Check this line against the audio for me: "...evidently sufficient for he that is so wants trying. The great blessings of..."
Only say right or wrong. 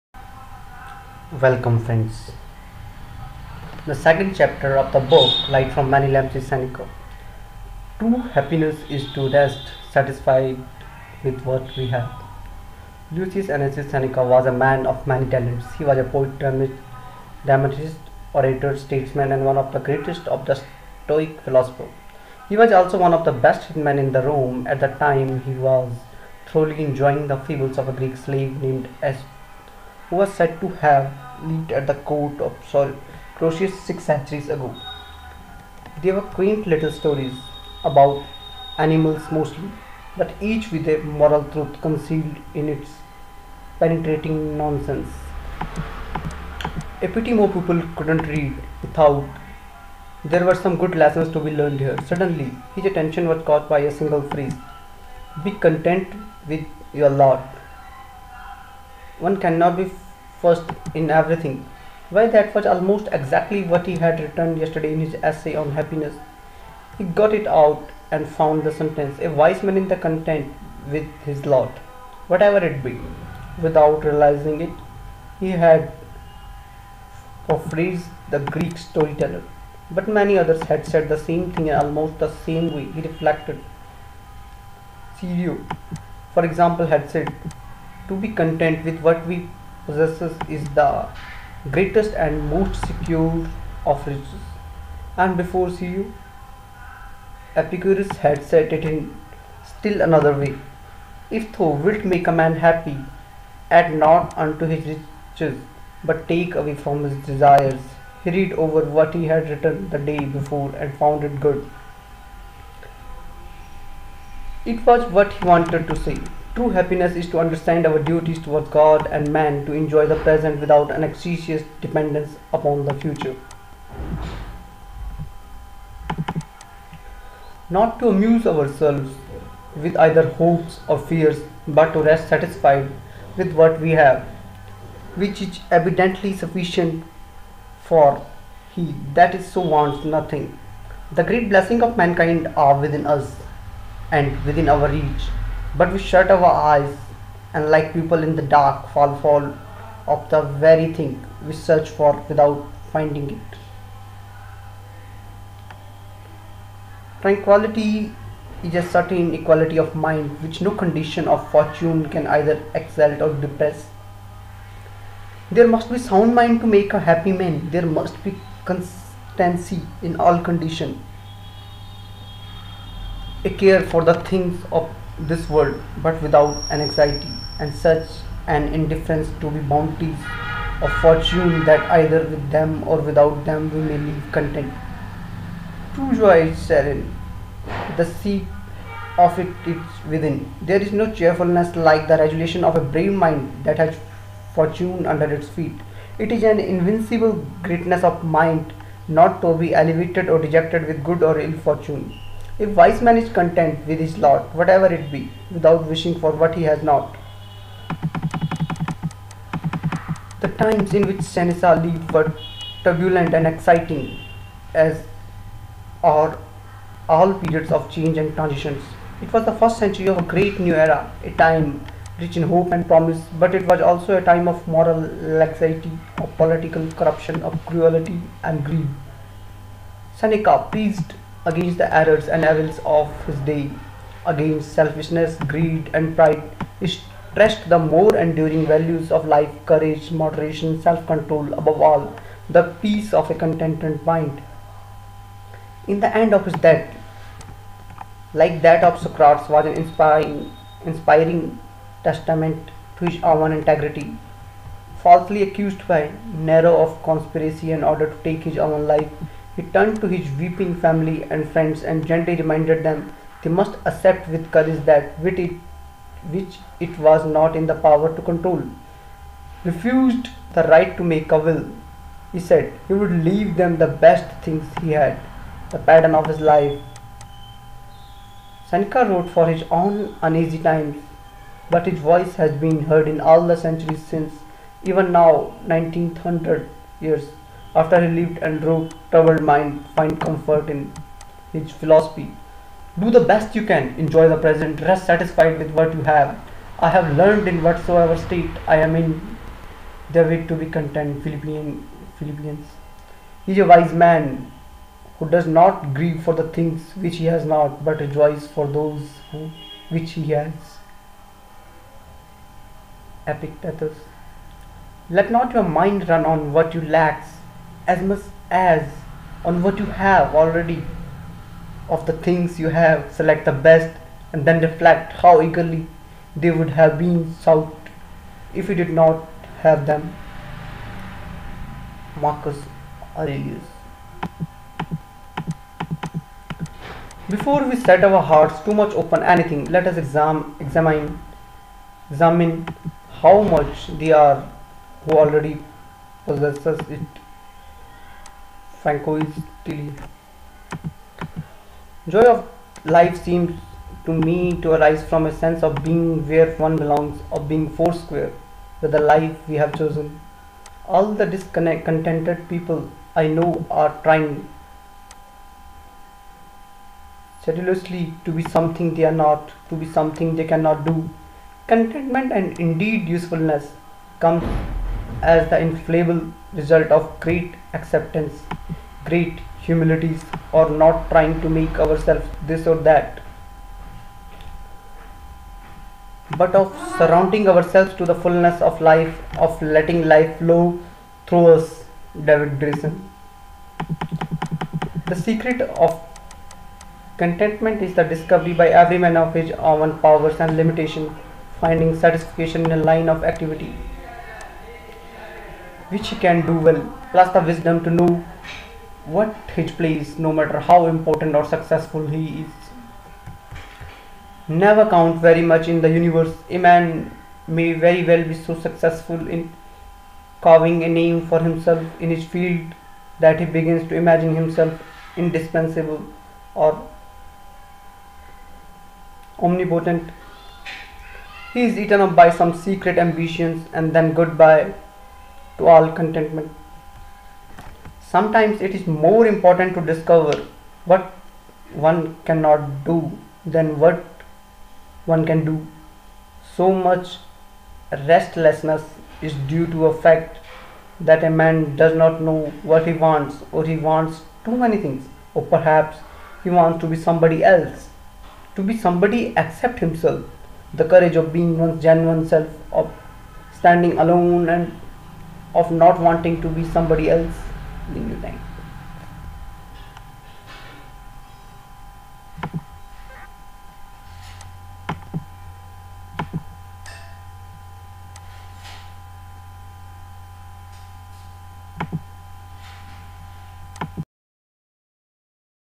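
wrong.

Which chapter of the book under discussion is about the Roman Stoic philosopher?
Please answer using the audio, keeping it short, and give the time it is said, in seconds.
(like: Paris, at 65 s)
second, at 3 s.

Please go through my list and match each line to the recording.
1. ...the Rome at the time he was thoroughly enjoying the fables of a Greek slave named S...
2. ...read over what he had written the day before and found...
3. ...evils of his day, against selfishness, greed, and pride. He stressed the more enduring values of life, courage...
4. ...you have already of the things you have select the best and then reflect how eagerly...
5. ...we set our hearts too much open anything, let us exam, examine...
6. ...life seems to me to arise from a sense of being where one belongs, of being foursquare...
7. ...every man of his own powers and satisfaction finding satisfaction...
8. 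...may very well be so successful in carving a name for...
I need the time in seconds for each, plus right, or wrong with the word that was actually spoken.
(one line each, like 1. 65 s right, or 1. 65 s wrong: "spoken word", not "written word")
1. 24 s right
2. 108 s right
3. 232 s right
4. 319 s right
5. 337 s right
6. 352 s right
7. 398 s wrong: "limitation", not "satisfaction"
8. 417 s right.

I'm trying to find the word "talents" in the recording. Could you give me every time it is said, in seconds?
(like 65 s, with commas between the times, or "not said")
15 s.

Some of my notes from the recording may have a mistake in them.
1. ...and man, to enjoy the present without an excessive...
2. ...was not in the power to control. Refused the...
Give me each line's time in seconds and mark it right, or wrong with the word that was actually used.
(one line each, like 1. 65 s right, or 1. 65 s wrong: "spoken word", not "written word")
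1. 119 s right
2. 266 s right.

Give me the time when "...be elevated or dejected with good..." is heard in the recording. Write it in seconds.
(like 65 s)
199 s.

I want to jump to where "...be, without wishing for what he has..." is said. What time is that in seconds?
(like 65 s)
205 s.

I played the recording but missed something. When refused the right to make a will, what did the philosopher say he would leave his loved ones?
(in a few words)
the pattern of his life.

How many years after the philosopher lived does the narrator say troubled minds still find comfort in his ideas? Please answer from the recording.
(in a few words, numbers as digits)
1900.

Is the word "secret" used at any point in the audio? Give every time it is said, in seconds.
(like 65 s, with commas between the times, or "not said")
395 s, 432 s.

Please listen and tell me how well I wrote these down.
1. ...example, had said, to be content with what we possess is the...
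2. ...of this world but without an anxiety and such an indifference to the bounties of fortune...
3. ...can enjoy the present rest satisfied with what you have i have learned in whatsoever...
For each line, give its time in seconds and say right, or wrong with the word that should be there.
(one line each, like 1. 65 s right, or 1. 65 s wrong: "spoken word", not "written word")
1. 86 s right
2. 174 s right
3. 293 s right.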